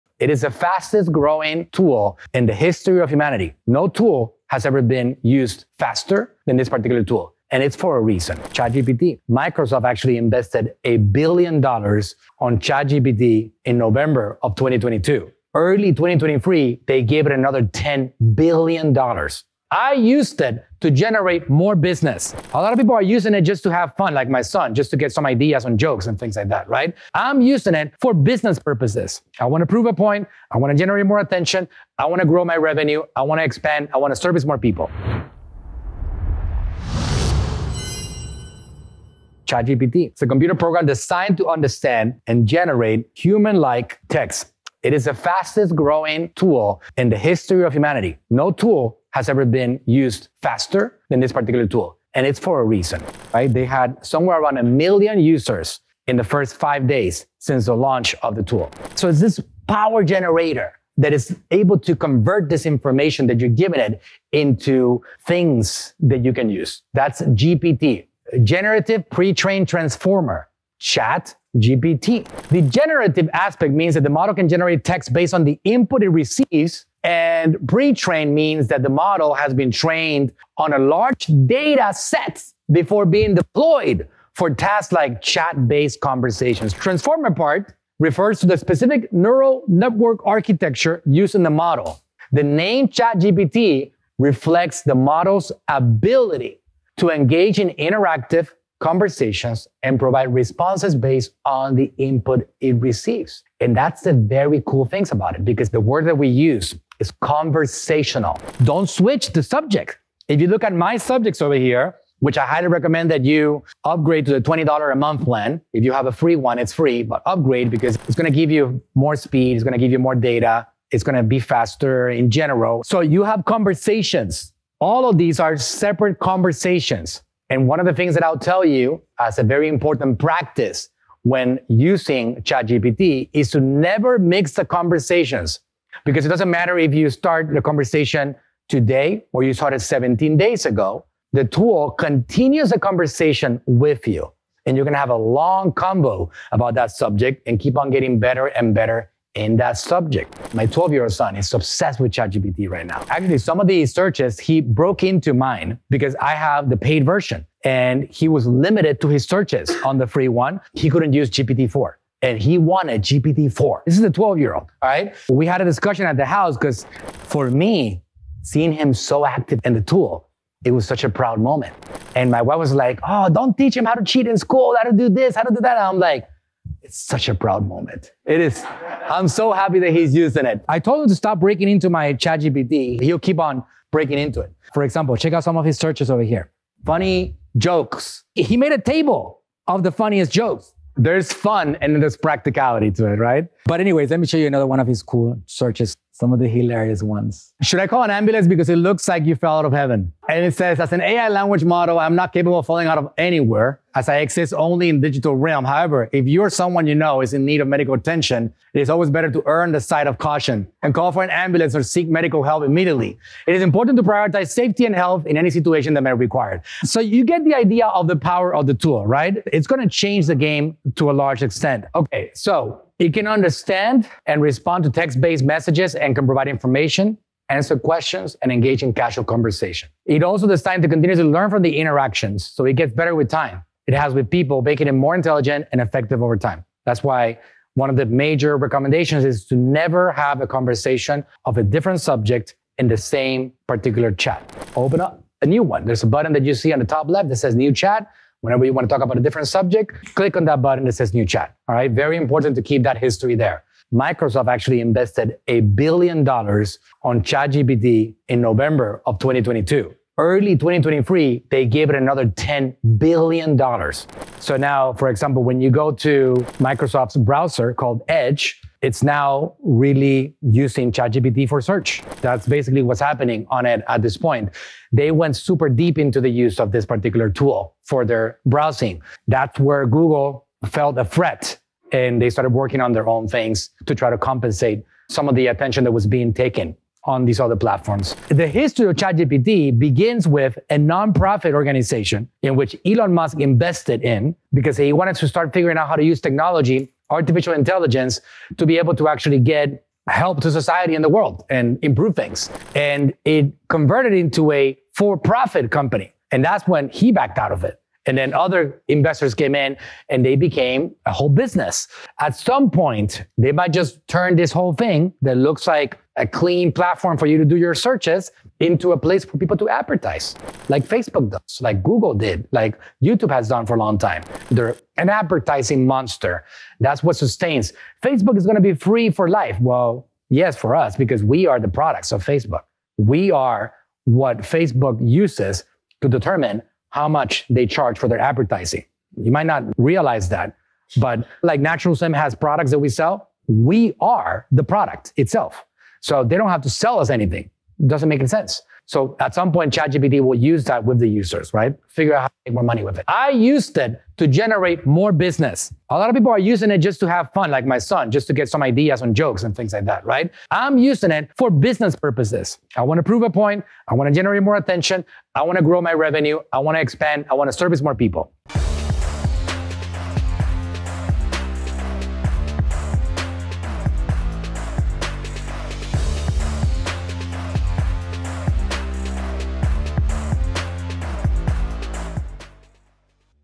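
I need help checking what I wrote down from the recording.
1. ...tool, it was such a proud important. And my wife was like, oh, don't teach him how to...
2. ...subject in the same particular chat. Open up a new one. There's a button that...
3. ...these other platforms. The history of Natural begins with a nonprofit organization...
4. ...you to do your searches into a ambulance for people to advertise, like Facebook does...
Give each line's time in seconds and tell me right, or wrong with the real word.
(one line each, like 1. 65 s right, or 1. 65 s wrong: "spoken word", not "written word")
1. 169 s wrong: "moment", not "important"
2. 242 s right
3. 287 s wrong: "ChatGPT", not "Natural"
4. 317 s wrong: "place", not "ambulance".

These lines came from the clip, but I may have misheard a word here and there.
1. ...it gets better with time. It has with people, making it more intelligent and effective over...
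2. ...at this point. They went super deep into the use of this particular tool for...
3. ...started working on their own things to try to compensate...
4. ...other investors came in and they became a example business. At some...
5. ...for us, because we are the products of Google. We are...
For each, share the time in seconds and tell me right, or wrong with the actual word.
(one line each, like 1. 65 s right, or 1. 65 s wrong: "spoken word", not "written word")
1. 232 s right
2. 273 s right
3. 282 s right
4. 308 s wrong: "whole", not "example"
5. 330 s wrong: "Facebook", not "Google".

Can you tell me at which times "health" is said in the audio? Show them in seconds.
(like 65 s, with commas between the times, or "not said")
214 s.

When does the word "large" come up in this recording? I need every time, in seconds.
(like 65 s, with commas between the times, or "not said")
80 s, 221 s.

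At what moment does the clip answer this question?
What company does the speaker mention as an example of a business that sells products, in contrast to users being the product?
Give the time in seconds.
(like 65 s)
341 s.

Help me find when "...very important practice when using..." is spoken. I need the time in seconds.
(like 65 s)
129 s.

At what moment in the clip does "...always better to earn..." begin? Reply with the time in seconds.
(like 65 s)
208 s.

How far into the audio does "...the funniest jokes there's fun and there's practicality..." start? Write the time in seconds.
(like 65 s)
189 s.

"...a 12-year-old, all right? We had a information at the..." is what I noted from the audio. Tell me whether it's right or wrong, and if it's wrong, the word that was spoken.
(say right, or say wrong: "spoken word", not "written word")
wrong: "discussion", not "information".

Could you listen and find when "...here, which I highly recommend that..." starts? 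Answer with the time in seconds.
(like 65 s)
111 s.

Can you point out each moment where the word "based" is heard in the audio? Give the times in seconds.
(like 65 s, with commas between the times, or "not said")
75 s, 85 s, 100 s, 225 s.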